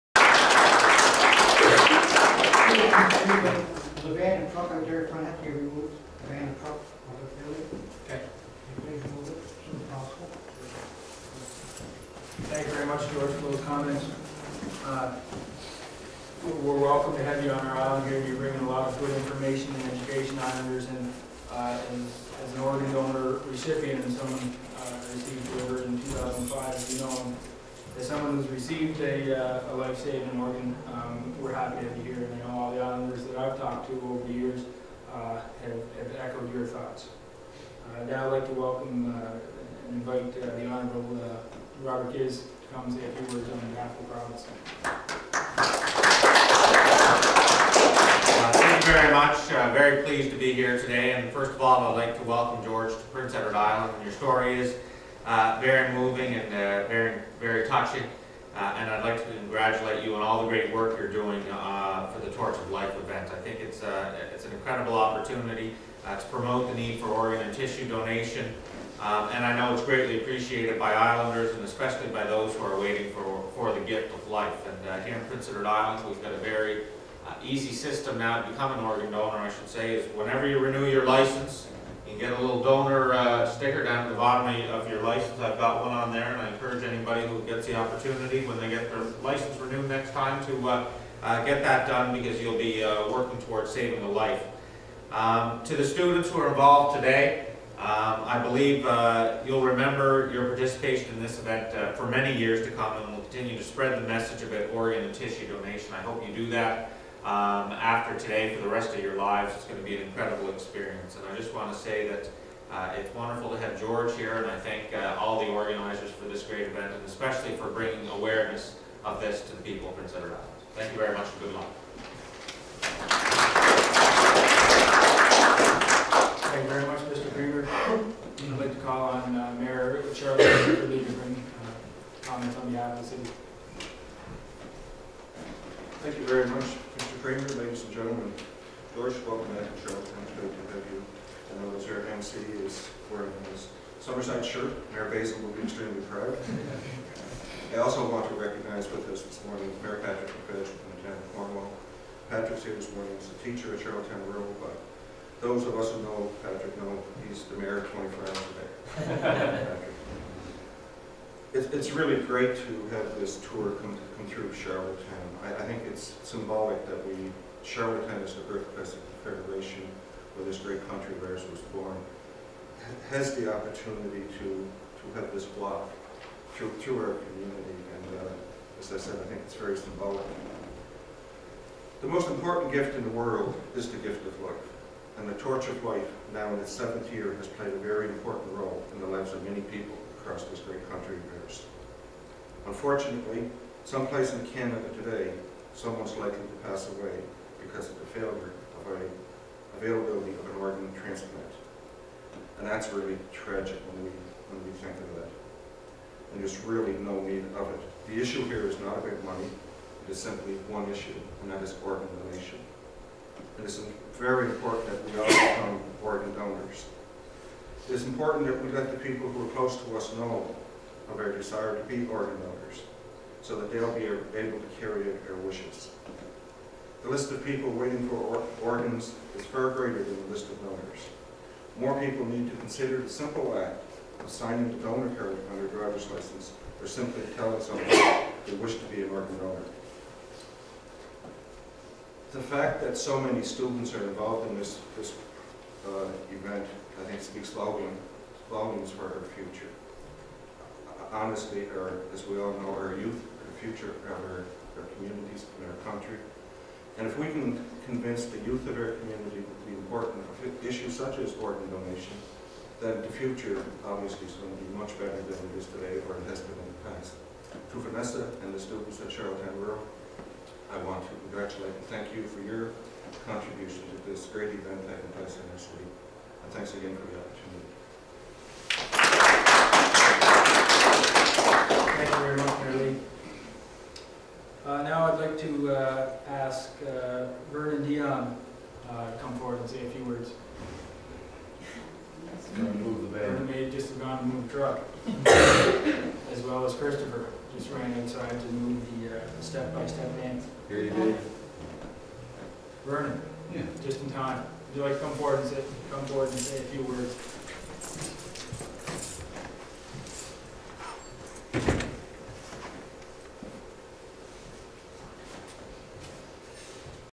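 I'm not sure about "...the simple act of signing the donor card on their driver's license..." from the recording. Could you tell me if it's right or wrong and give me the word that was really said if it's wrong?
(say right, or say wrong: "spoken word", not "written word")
right.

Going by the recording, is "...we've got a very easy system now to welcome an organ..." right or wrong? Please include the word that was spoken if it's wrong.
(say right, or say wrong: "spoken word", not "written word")
wrong: "become", not "welcome".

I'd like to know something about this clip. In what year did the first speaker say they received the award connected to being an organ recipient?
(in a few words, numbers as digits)
2005.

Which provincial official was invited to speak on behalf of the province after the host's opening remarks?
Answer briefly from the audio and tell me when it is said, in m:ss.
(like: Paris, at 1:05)
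Robert Ghiz, at 0:41.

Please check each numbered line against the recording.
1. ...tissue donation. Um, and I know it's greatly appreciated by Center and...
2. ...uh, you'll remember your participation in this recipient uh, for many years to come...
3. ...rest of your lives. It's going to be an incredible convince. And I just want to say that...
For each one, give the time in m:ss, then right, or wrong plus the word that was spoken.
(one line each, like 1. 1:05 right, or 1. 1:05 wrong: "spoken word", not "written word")
1. 1:07 wrong: "Islanders", not "Center"
2. 1:38 wrong: "event", not "recipient"
3. 1:48 wrong: "experience", not "convince".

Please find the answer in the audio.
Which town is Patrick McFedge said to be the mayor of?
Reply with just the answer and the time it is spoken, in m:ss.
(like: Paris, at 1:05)
Cornwall, at 2:31.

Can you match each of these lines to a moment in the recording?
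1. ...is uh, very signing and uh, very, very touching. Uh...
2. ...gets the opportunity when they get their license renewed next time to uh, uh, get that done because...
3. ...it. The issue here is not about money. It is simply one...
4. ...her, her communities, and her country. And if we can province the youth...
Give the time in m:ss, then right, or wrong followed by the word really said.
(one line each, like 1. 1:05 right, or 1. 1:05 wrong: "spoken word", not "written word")
1. 0:54 wrong: "moving", not "signing"
2. 1:27 right
3. 3:27 right
4. 4:14 wrong: "convince", not "province".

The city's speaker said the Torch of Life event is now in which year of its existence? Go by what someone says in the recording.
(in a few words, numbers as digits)
Seventh.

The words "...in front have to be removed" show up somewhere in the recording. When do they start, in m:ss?
0:05.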